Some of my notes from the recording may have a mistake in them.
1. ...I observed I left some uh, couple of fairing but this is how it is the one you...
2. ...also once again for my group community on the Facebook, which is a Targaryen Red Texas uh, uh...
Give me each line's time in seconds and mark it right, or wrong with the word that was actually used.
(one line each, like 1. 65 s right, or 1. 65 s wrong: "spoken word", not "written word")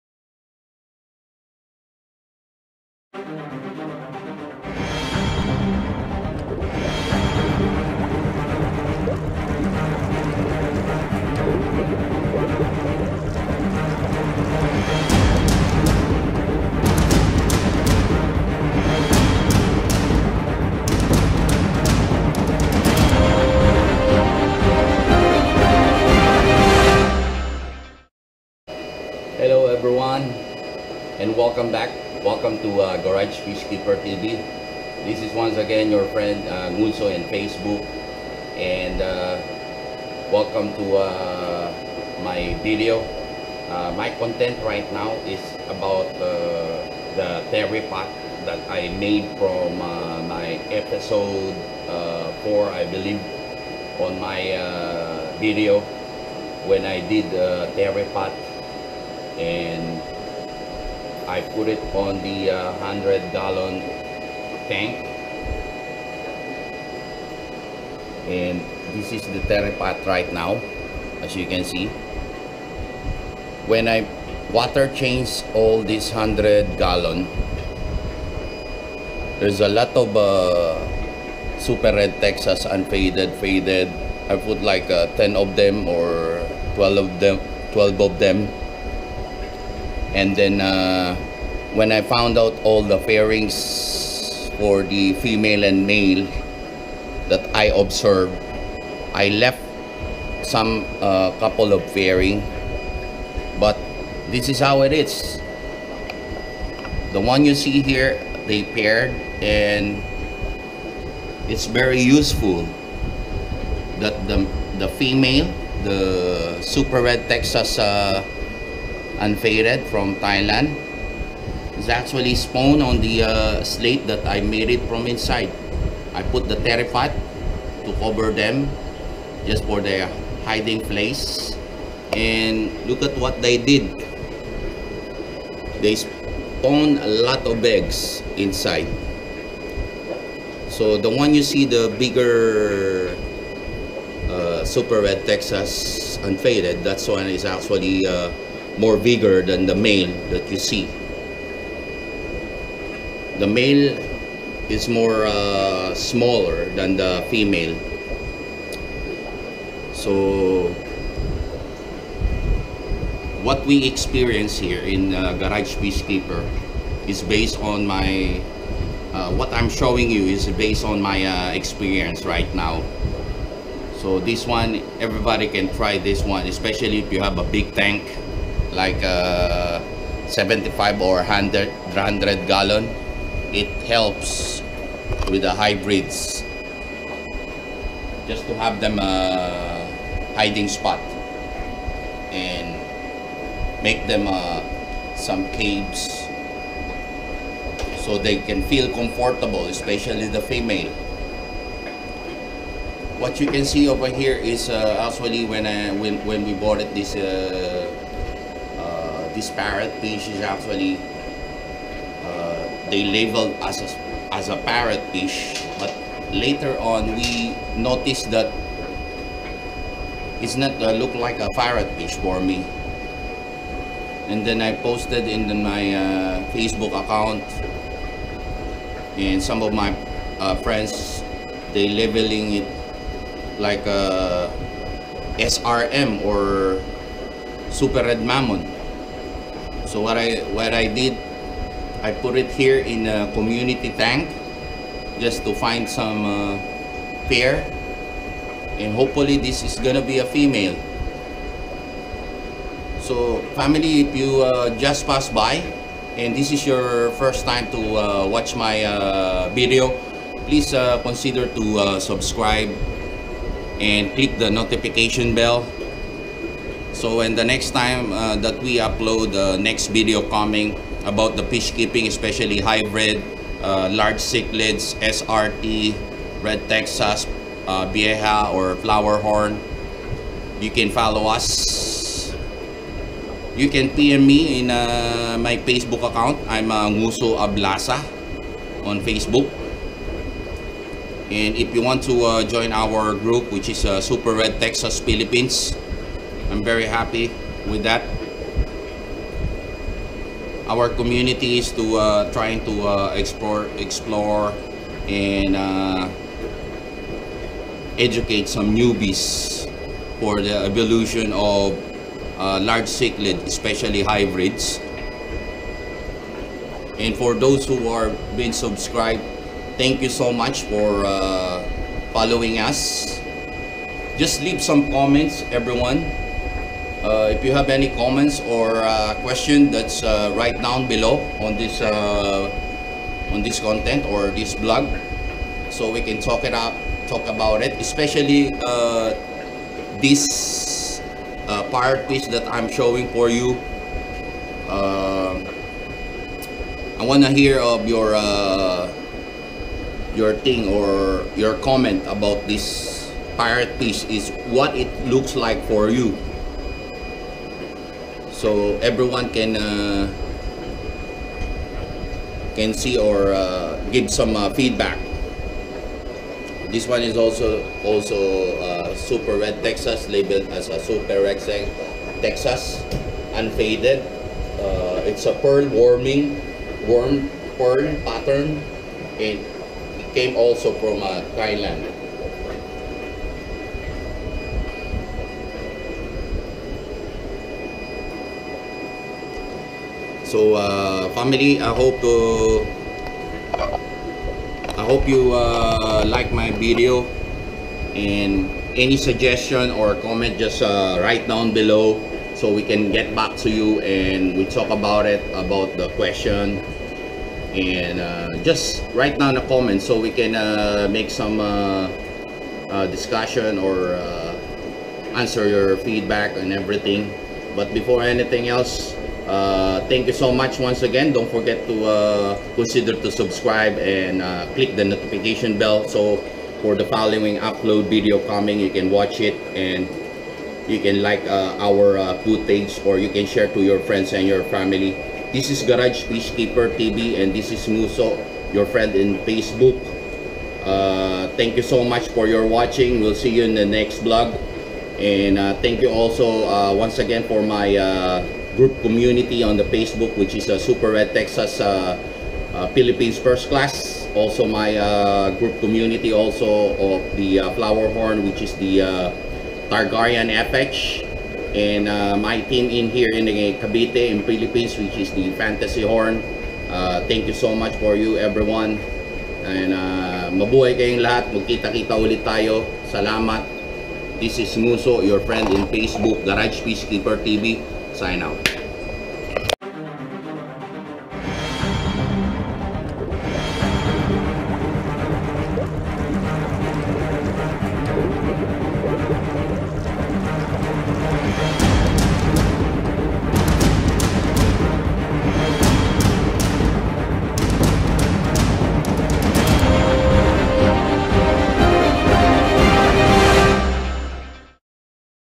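1. 97 s right
2. 445 s wrong: "Super", not "Targaryen".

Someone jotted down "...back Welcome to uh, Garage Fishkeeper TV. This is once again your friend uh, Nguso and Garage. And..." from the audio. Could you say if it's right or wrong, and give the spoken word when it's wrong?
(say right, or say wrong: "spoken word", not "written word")
wrong: "Facebook", not "Garage".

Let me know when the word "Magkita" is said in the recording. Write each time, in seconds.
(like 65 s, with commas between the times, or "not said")
471 s.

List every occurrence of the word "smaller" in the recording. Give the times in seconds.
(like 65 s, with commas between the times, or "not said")
155 s.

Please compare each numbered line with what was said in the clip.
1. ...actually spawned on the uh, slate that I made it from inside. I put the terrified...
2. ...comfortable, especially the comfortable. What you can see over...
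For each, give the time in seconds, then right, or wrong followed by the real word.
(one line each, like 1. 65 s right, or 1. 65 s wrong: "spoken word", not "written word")
1. 121 s right
2. 198 s wrong: "female", not "comfortable".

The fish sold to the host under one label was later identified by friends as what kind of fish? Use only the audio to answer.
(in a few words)
super red mammon.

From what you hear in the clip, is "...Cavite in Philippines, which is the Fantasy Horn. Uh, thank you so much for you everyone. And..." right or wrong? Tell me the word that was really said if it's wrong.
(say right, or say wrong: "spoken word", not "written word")
right.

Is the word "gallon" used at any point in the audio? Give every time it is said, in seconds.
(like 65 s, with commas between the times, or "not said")
63 s, 76 s, 182 s.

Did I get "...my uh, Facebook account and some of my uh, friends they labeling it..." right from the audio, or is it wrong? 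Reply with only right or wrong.
right.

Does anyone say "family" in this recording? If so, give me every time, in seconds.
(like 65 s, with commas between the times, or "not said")
253 s, 391 s, 434 s.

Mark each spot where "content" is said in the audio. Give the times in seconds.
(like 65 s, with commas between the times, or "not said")
44 s, 333 s.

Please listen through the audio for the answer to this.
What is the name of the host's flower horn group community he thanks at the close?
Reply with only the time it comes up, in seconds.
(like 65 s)
459 s.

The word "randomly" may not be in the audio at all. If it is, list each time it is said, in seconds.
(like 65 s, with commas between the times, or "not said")
not said.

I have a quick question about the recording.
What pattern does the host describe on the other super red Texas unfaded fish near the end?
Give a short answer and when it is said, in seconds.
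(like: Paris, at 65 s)
pearl pattern, at 377 s.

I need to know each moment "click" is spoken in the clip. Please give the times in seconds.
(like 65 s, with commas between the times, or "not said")
264 s, 424 s.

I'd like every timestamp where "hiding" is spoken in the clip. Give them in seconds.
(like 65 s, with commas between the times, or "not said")
130 s, 190 s.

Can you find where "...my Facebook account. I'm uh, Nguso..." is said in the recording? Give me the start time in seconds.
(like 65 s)
285 s.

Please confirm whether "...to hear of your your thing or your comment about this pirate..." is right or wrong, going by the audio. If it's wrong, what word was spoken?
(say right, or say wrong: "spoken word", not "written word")
right.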